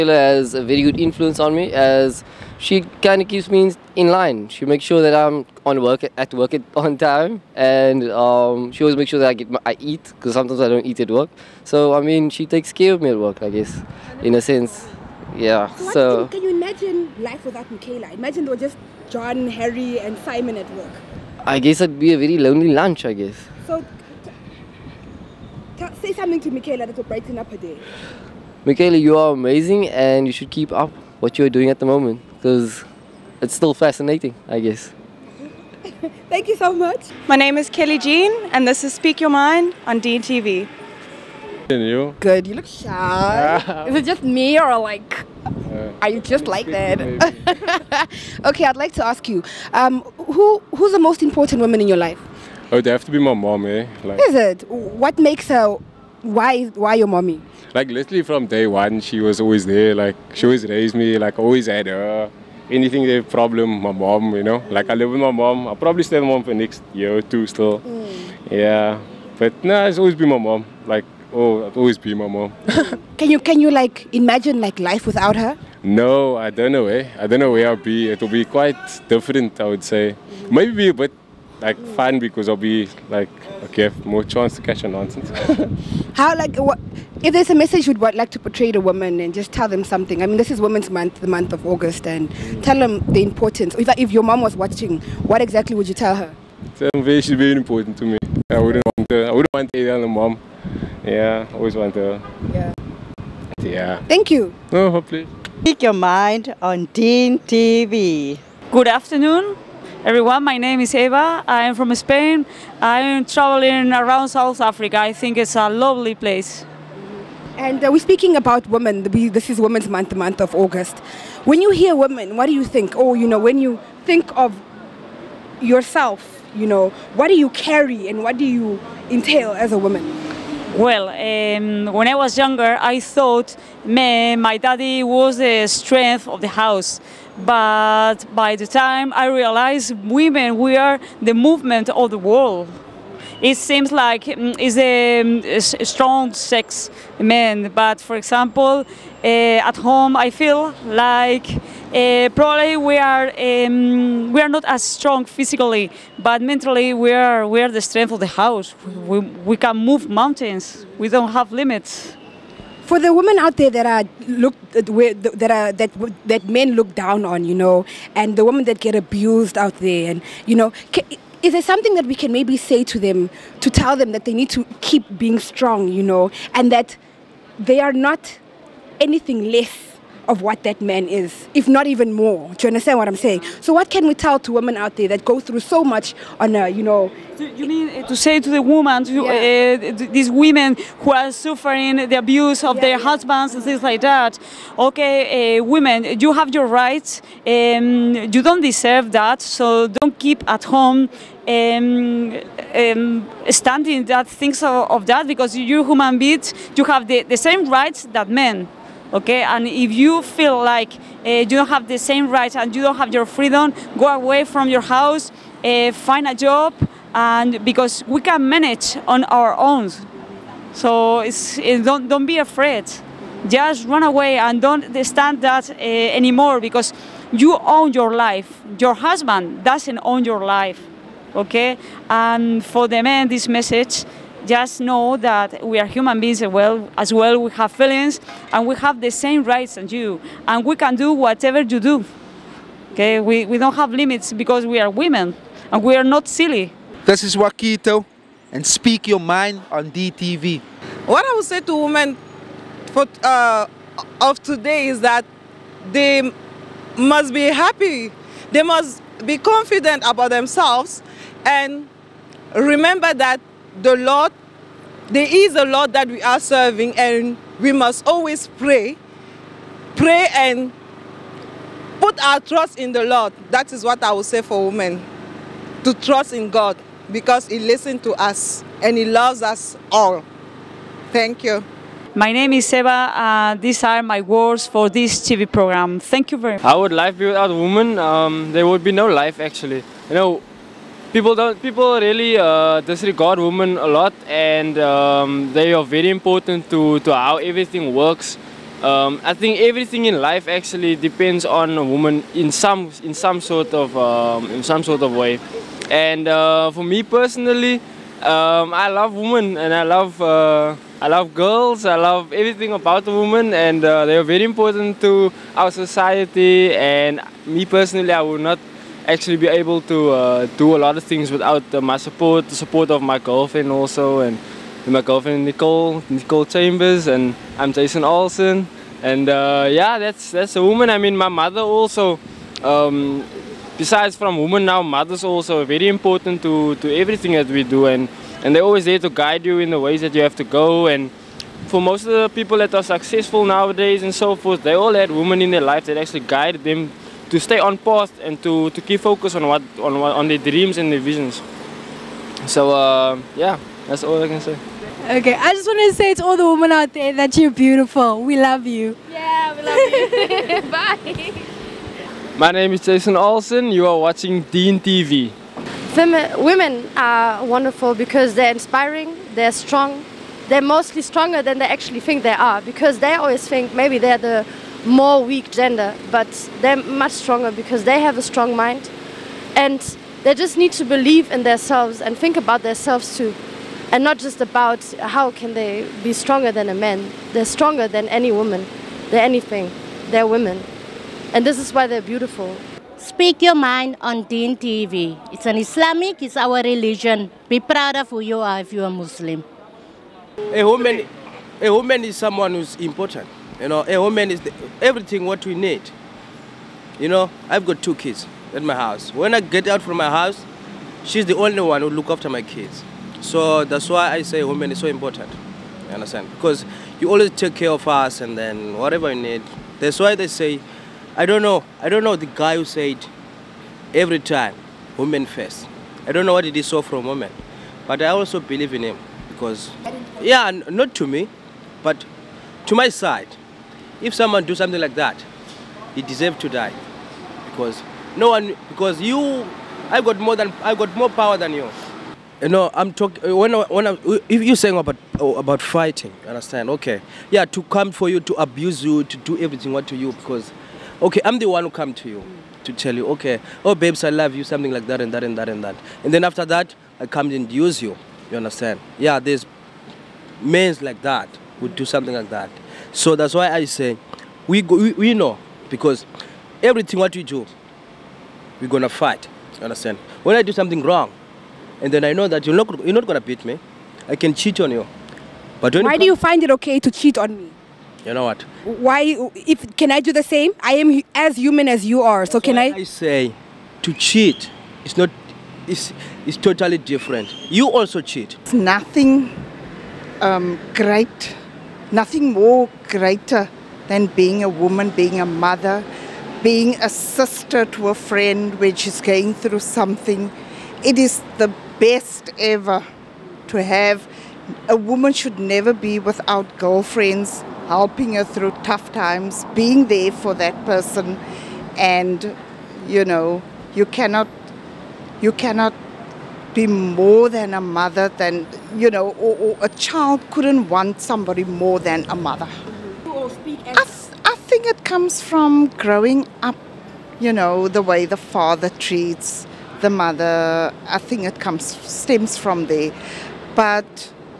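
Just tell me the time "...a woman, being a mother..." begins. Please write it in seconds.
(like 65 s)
494 s.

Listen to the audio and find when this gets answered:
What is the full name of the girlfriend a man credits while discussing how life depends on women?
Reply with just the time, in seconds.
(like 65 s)
326 s.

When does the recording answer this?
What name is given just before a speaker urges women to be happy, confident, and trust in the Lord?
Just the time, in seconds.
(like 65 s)
247 s.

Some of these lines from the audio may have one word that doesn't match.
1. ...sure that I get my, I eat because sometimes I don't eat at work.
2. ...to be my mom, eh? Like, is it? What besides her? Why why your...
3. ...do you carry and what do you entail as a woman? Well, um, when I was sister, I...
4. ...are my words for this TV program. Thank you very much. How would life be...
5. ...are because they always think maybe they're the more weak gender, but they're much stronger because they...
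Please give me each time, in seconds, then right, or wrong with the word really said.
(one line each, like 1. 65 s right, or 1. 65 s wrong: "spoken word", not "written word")
1. 9 s right
2. 53 s wrong: "makes", not "besides"
3. 127 s wrong: "younger", not "sister"
4. 283 s right
5. 372 s right.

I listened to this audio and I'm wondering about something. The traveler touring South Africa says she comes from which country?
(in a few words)
Spain.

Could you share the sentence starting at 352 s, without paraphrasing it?
So uh, yeah, that's all I can say.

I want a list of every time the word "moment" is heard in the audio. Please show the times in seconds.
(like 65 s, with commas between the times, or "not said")
31 s.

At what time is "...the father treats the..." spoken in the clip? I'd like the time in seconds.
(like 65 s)
528 s.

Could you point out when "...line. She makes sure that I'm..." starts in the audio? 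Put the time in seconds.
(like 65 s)
4 s.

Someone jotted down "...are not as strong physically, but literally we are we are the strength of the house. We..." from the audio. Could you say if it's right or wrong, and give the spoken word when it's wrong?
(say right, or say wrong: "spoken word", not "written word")
wrong: "mentally", not "literally".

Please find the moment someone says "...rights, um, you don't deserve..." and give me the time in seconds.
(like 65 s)
196 s.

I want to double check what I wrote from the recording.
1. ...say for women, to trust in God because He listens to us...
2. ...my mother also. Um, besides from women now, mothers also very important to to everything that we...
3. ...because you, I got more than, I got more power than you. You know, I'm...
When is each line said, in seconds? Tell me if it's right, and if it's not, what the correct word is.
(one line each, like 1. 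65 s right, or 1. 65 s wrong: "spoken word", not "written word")
1. 274 s right
2. 331 s right
3. 438 s right.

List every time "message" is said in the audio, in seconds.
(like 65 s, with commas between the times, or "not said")
87 s, 233 s.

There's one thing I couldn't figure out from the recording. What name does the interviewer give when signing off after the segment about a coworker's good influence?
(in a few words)
Kelly Jean.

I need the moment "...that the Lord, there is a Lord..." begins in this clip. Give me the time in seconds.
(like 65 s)
263 s.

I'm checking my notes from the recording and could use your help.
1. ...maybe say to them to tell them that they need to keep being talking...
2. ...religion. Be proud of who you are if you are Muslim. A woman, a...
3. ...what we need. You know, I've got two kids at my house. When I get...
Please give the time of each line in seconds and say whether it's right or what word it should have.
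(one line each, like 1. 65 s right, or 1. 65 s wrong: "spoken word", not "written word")
1. 172 s wrong: "strong", not "talking"
2. 396 s right
3. 405 s right.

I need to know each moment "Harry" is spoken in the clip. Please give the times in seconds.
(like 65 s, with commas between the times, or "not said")
19 s.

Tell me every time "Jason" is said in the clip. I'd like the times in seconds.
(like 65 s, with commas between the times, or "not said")
327 s, 362 s.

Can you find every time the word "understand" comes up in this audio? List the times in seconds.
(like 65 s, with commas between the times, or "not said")
182 s, 415 s, 446 s, 458 s, 469 s.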